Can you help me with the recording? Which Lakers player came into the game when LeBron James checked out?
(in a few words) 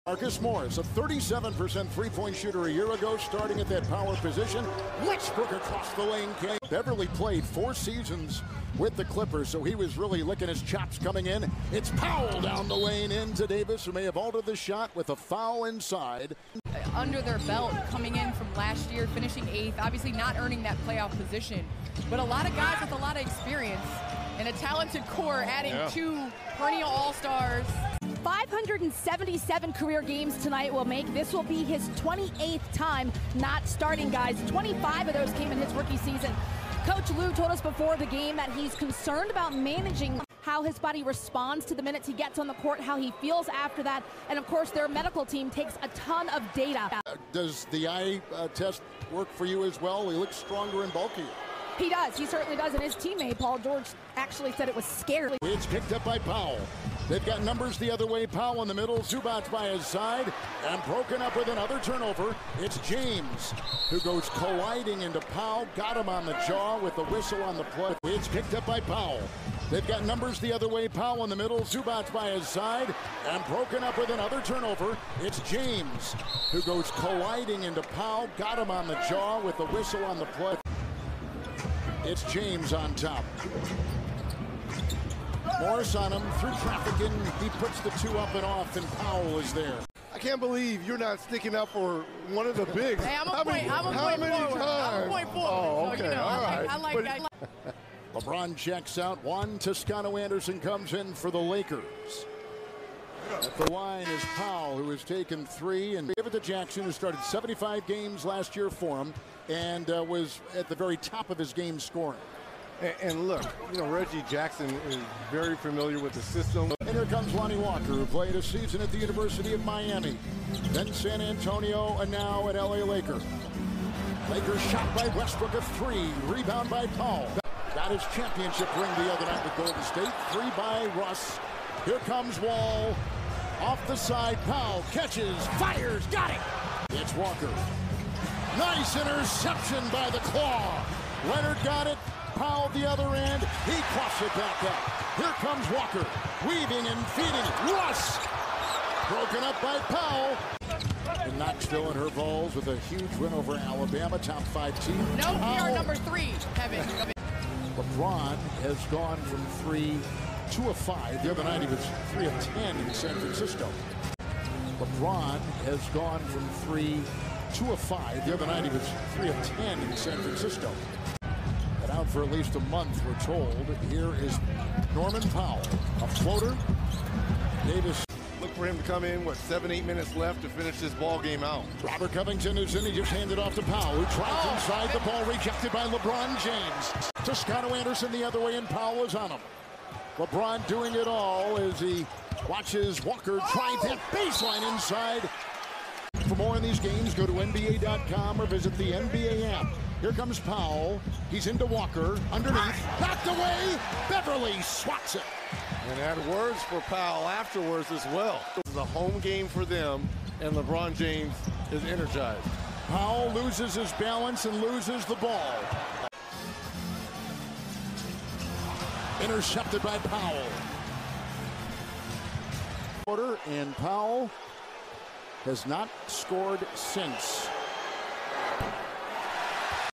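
Juan Toscano Anderson.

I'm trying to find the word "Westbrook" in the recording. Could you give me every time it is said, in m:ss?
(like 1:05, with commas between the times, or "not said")
0:05, 2:05.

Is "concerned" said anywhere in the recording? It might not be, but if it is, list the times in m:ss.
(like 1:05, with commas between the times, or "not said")
0:38.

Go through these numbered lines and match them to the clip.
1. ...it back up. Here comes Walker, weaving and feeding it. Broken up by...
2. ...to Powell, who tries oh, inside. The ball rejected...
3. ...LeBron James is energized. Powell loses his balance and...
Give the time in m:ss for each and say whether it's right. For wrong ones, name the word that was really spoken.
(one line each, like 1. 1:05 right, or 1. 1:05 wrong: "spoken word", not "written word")
1. 2:24 right
2. 3:03 right
3. 3:30 right.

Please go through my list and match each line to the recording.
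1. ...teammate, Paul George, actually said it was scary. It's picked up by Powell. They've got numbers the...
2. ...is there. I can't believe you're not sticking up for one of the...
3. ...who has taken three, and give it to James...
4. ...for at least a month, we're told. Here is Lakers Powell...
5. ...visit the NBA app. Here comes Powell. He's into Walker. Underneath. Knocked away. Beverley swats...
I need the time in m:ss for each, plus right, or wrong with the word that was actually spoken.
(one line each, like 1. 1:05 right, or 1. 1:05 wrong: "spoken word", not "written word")
1. 0:52 right
2. 1:29 right
3. 1:44 wrong: "Jackson", not "James"
4. 2:52 wrong: "Norman", not "Lakers"
5. 3:18 right.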